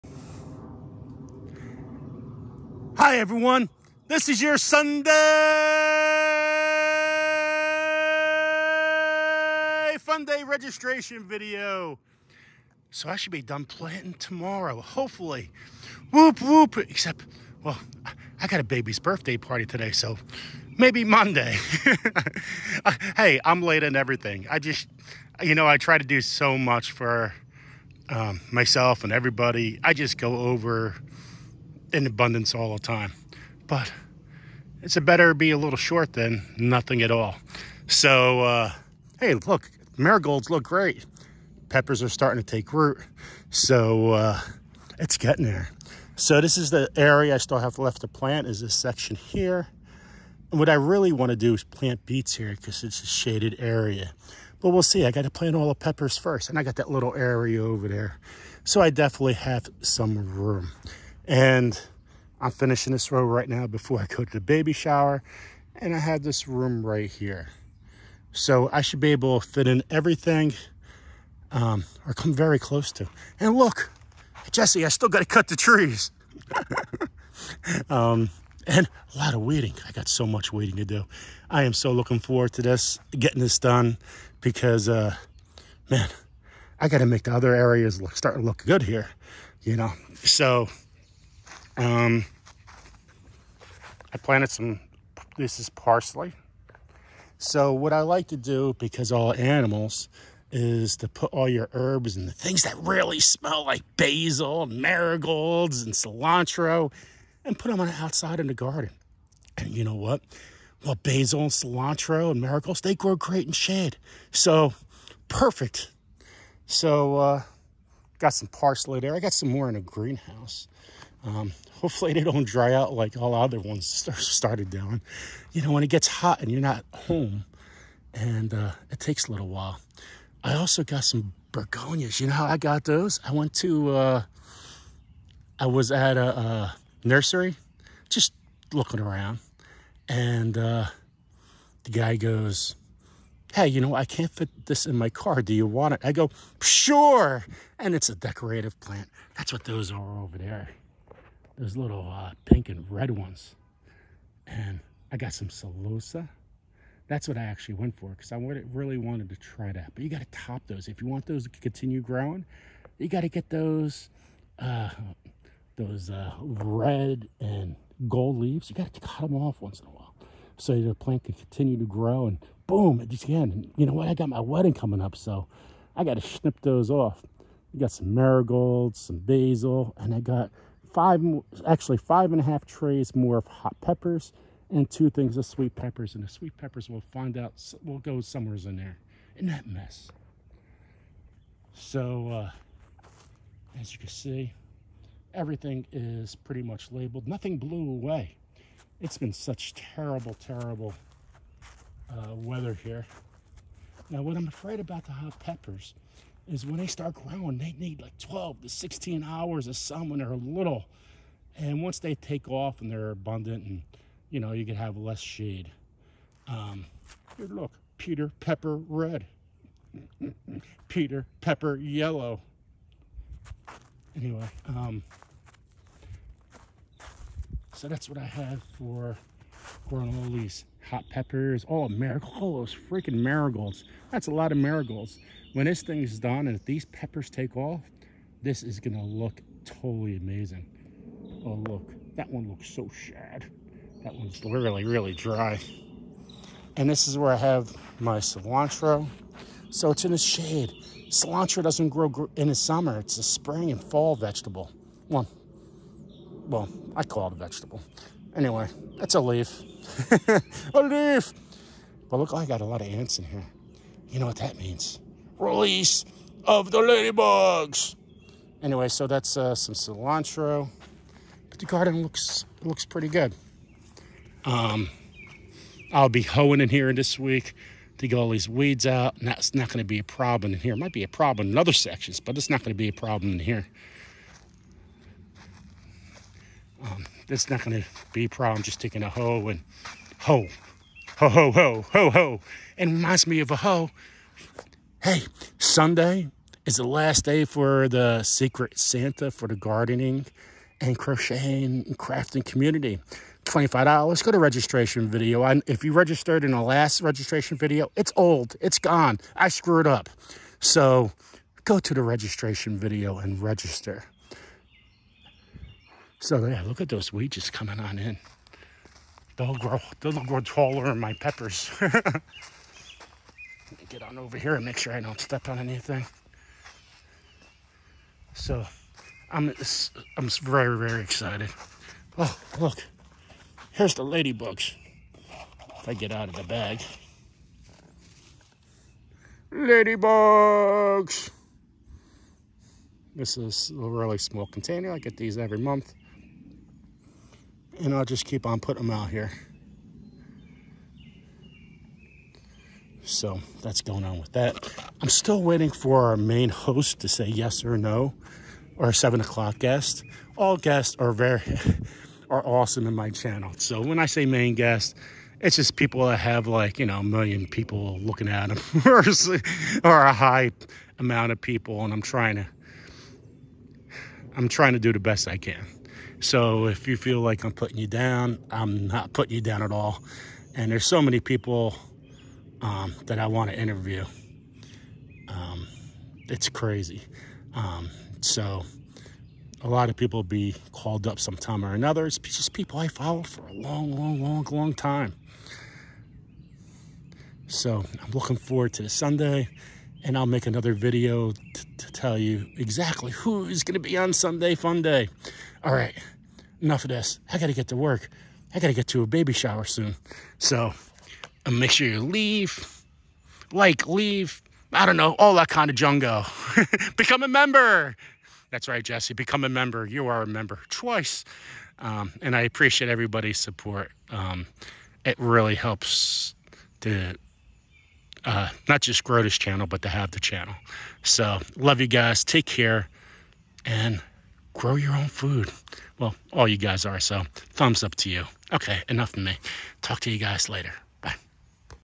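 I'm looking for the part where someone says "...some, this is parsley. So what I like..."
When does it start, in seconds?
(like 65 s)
94 s.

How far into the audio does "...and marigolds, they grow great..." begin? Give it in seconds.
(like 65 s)
112 s.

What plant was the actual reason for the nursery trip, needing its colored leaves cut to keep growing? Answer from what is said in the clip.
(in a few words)
Celosia.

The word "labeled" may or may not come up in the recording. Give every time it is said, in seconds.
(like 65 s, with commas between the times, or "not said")
196 s.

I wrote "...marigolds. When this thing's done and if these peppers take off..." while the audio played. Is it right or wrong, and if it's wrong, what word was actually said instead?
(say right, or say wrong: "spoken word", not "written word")
right.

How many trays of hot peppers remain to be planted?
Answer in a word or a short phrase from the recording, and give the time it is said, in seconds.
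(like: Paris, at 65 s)
5 and a half, at 181 s.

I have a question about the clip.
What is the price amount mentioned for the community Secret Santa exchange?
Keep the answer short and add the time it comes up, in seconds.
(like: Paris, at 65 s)
$25, at 303 s.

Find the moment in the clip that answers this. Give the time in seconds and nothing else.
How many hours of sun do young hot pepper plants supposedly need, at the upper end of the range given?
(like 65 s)
208 s.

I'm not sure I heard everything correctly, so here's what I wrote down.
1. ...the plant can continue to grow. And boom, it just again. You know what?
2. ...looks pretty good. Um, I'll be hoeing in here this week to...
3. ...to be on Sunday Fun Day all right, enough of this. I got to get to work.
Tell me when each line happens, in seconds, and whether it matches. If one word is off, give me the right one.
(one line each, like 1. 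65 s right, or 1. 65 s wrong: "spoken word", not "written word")
1. 170 s right
2. 272 s right
3. 403 s right.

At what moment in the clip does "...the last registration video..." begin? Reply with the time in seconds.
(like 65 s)
306 s.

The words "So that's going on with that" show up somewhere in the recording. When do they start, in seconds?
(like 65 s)
353 s.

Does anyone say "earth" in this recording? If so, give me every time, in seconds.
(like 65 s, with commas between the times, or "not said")
not said.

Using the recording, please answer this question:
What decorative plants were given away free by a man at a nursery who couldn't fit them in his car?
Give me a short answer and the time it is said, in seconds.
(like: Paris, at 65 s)
Begonias, at 131 s.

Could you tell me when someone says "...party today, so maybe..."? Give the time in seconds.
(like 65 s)
19 s.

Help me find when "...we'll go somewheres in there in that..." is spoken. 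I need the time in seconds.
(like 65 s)
187 s.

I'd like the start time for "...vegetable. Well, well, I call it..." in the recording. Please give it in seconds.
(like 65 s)
254 s.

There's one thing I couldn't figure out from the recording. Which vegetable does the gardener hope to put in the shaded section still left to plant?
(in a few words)
Beets.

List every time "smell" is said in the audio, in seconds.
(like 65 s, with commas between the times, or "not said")
103 s.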